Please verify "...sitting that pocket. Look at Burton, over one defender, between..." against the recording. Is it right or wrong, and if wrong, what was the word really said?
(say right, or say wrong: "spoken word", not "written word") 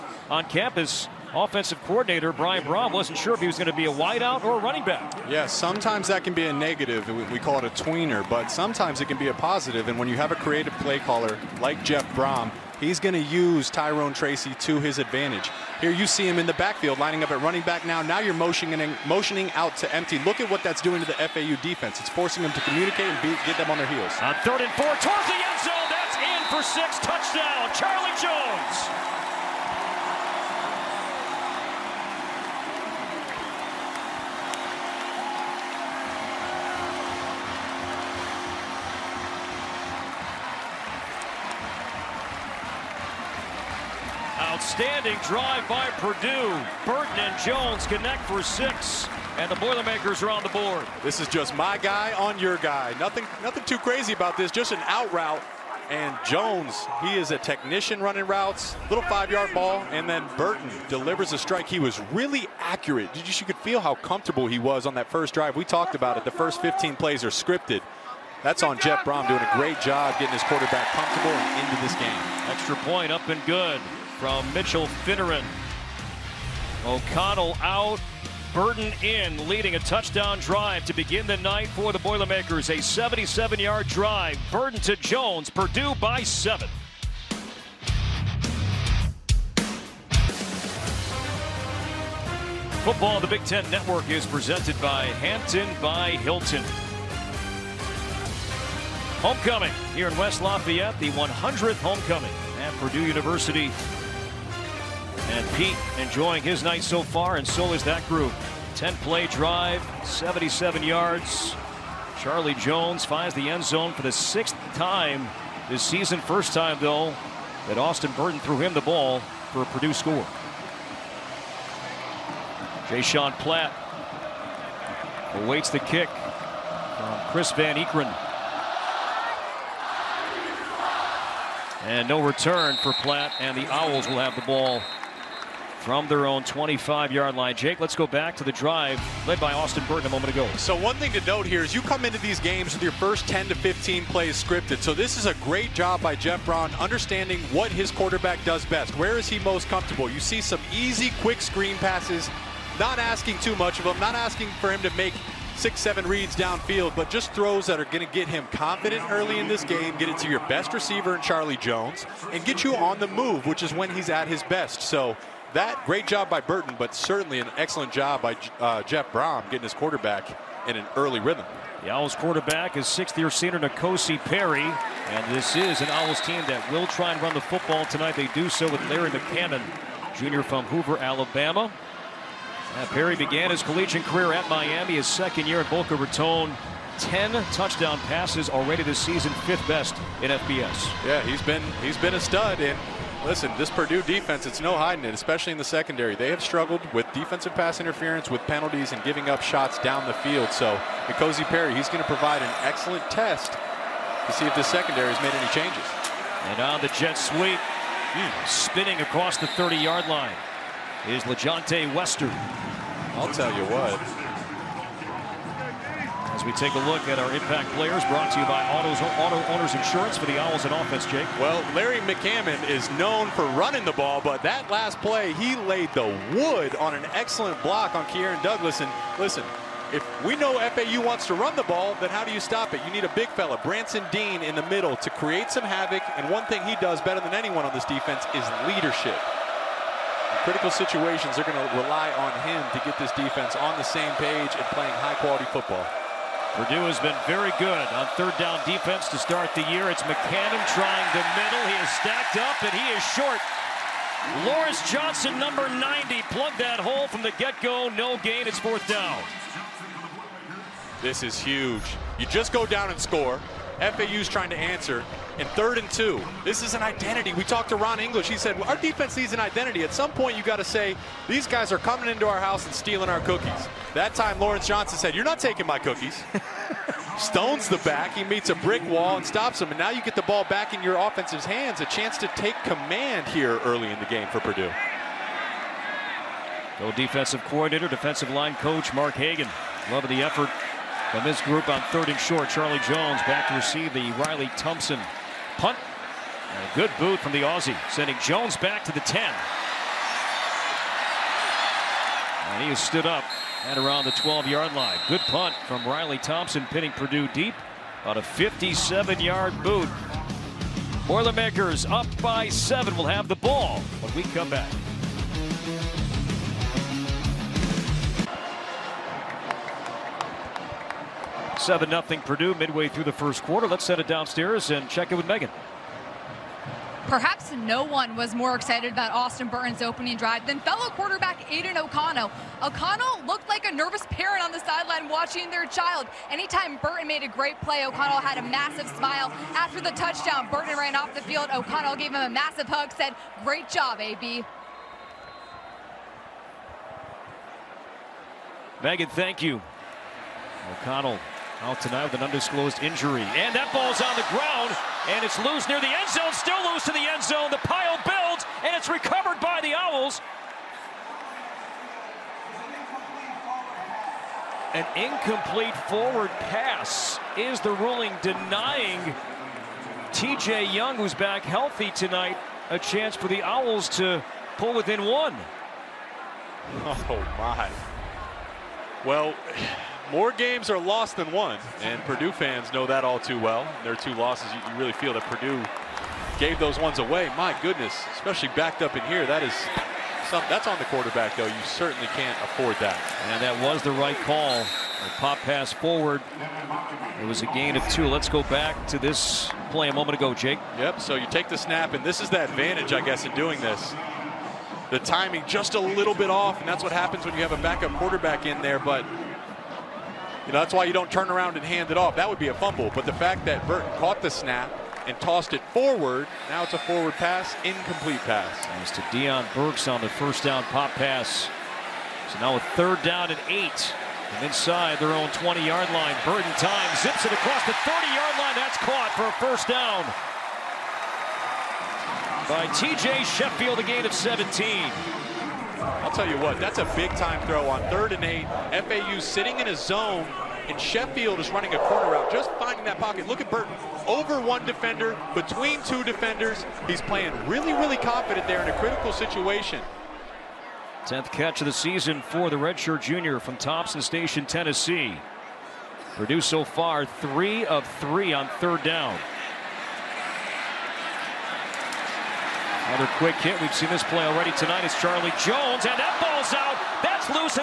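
wrong: "finding", not "sitting".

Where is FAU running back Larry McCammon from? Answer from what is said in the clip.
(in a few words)
Hoover, Alabama.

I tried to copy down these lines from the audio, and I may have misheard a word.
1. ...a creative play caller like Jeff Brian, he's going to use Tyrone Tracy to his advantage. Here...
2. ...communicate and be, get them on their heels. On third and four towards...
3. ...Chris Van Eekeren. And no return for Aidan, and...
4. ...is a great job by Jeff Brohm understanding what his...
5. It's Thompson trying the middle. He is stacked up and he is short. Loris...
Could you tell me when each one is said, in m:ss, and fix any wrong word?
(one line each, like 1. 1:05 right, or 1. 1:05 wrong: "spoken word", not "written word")
1. 0:10 wrong: "Brohm", not "Brian"
2. 0:22 right
3. 2:07 wrong: "Platt", not "Aidan"
4. 2:25 right
5. 4:09 wrong: "McCammon", not "Thompson".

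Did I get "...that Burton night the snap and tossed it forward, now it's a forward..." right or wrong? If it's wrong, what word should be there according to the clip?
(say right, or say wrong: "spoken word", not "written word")
wrong: "caught", not "night".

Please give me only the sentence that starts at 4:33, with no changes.
That time, Lawrence Johnson said, you're not taking my cookies.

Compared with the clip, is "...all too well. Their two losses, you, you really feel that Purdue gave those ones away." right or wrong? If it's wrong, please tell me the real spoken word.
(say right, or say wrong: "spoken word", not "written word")
right.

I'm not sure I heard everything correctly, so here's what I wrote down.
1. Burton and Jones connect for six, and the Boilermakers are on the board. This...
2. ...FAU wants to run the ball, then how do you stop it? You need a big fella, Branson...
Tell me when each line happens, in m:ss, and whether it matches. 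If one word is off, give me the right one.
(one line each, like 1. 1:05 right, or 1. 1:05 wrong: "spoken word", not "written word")
1. 0:46 right
2. 3:50 right.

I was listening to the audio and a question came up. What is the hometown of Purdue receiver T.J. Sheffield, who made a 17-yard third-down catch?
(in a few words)
Thompson Station, Tennessee.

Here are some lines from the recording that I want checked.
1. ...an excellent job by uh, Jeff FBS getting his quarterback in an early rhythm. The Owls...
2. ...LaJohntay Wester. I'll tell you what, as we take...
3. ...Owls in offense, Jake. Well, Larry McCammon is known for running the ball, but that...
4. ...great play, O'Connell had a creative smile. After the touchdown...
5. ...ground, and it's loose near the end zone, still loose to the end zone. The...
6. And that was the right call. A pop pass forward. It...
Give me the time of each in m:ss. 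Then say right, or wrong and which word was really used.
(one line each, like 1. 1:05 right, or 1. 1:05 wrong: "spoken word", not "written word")
1. 2:47 wrong: "Brohm", not "FBS"
2. 3:31 right
3. 3:40 right
4. 5:37 wrong: "massive", not "creative"
5. 5:54 right
6. 6:33 right.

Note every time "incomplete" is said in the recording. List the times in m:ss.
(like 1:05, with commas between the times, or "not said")
6:04, 6:57.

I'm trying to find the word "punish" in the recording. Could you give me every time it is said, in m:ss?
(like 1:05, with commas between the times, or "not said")
not said.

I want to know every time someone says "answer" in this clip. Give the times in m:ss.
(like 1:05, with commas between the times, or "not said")
4:24.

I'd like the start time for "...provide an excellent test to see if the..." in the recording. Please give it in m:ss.
3:22.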